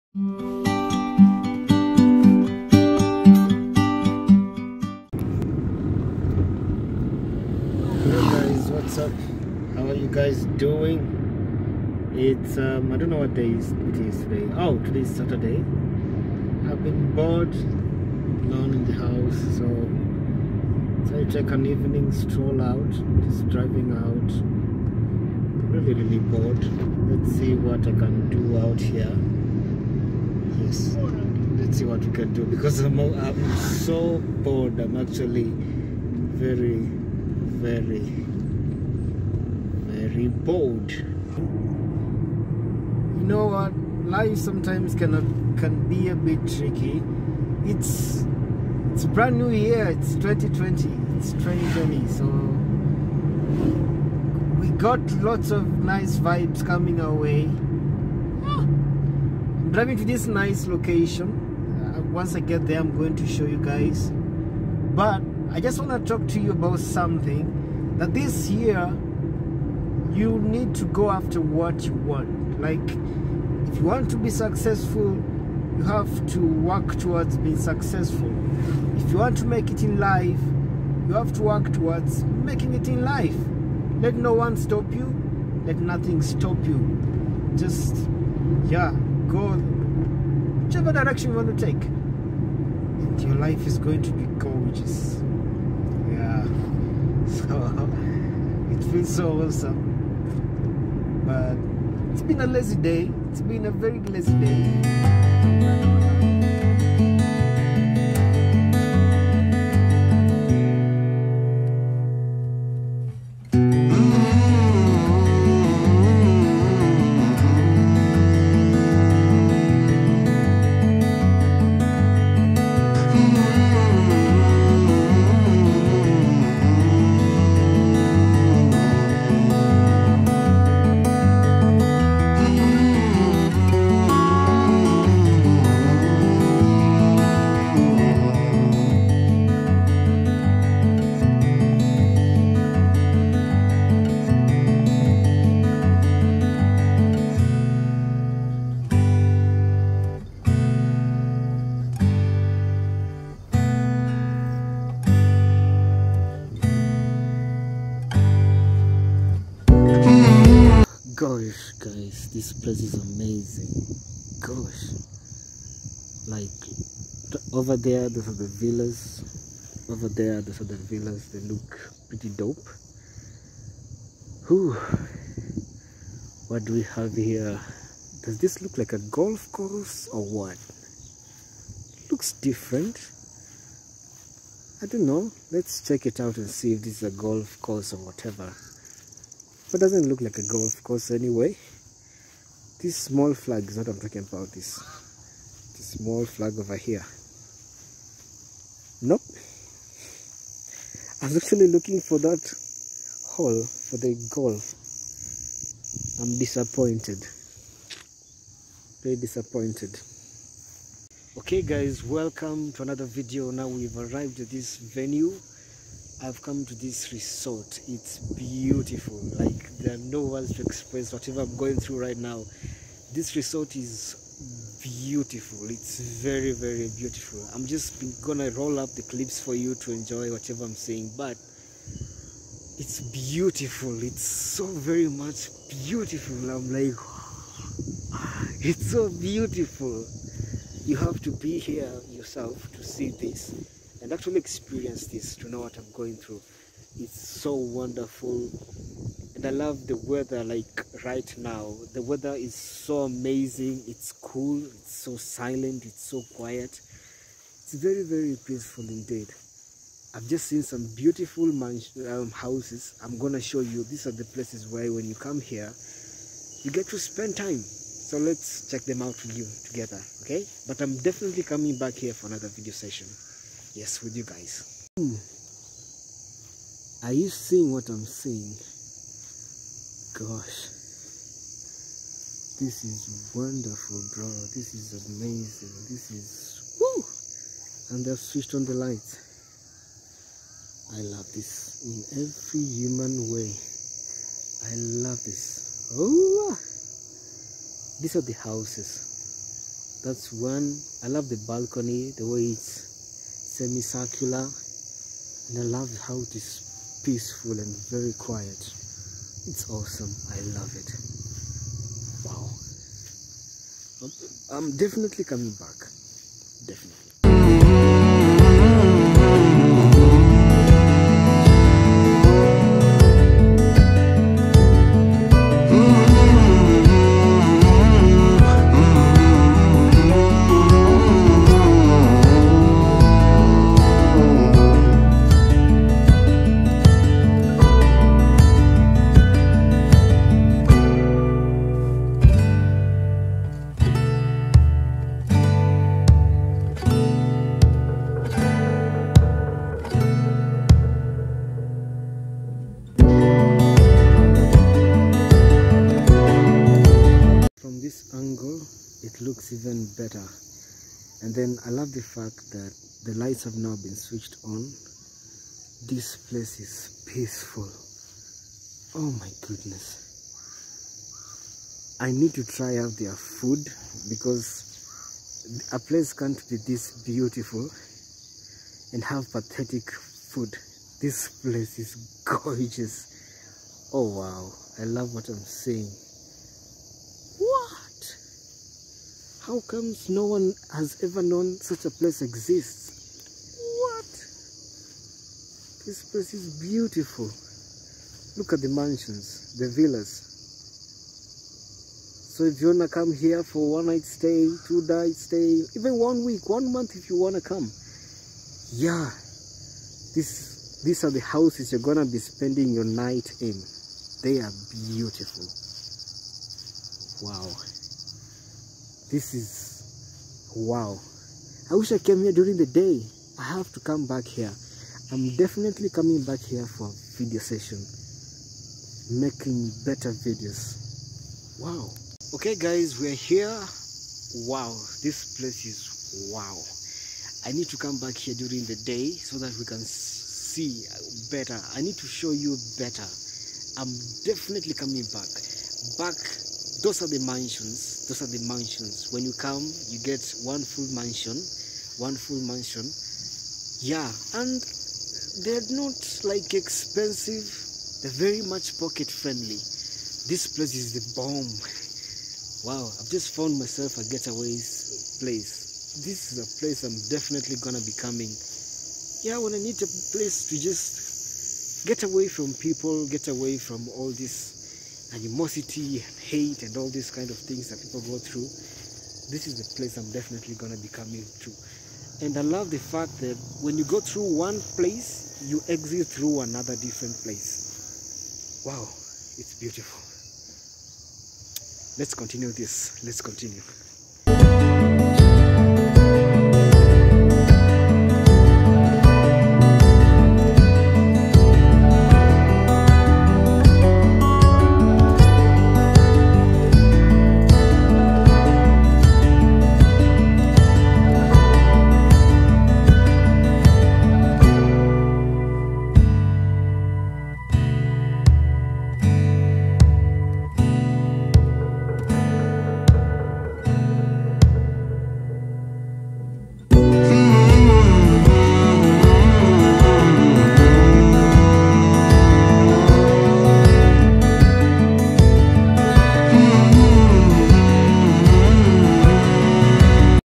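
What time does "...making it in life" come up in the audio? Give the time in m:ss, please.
1:22.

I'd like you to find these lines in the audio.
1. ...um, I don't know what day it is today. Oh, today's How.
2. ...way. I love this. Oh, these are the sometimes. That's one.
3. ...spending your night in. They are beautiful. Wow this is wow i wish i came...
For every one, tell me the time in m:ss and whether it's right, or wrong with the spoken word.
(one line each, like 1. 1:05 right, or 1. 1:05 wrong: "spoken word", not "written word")
1. 0:12 wrong: "Saturday", not "How"
2. 4:53 wrong: "houses", not "sometimes"
3. 6:52 right.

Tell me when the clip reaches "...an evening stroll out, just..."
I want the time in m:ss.
0:21.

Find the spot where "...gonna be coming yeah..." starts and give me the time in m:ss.
7:47.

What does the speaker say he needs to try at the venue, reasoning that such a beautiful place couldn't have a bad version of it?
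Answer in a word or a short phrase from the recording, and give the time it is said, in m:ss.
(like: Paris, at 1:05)
Their food, at 6:12.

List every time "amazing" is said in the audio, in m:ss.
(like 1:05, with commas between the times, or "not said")
2:42, 4:13, 4:45.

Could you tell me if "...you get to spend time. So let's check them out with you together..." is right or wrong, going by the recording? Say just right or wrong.
right.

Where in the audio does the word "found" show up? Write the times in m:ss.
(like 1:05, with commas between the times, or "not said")
7:43.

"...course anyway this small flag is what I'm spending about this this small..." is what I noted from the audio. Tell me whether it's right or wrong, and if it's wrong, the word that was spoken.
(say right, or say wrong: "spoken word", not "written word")
wrong: "talking", not "spending".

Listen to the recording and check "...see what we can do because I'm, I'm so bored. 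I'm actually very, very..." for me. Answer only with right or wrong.
right.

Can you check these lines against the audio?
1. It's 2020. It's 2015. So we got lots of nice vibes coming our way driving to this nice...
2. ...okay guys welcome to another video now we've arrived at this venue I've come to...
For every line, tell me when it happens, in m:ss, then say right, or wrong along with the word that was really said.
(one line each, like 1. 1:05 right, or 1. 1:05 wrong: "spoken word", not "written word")
1. 0:49 wrong: "2020", not "2015"
2. 3:31 right.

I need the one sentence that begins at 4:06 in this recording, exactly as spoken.
It's so wonderful and I love the weather like right now.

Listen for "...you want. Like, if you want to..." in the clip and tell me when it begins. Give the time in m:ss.
1:11.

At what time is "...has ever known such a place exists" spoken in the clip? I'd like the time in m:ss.
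6:30.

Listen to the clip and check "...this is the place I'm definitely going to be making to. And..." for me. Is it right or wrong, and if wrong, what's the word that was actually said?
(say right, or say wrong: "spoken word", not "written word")
wrong: "coming", not "making".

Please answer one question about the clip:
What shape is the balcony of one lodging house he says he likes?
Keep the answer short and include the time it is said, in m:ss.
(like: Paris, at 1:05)
Semicircular, at 5:03.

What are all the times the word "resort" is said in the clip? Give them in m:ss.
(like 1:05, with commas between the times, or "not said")
3:37, 3:43.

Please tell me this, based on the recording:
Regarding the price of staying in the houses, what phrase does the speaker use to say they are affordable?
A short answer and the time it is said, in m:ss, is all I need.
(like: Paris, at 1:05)
Pocket friendly, at 7:38.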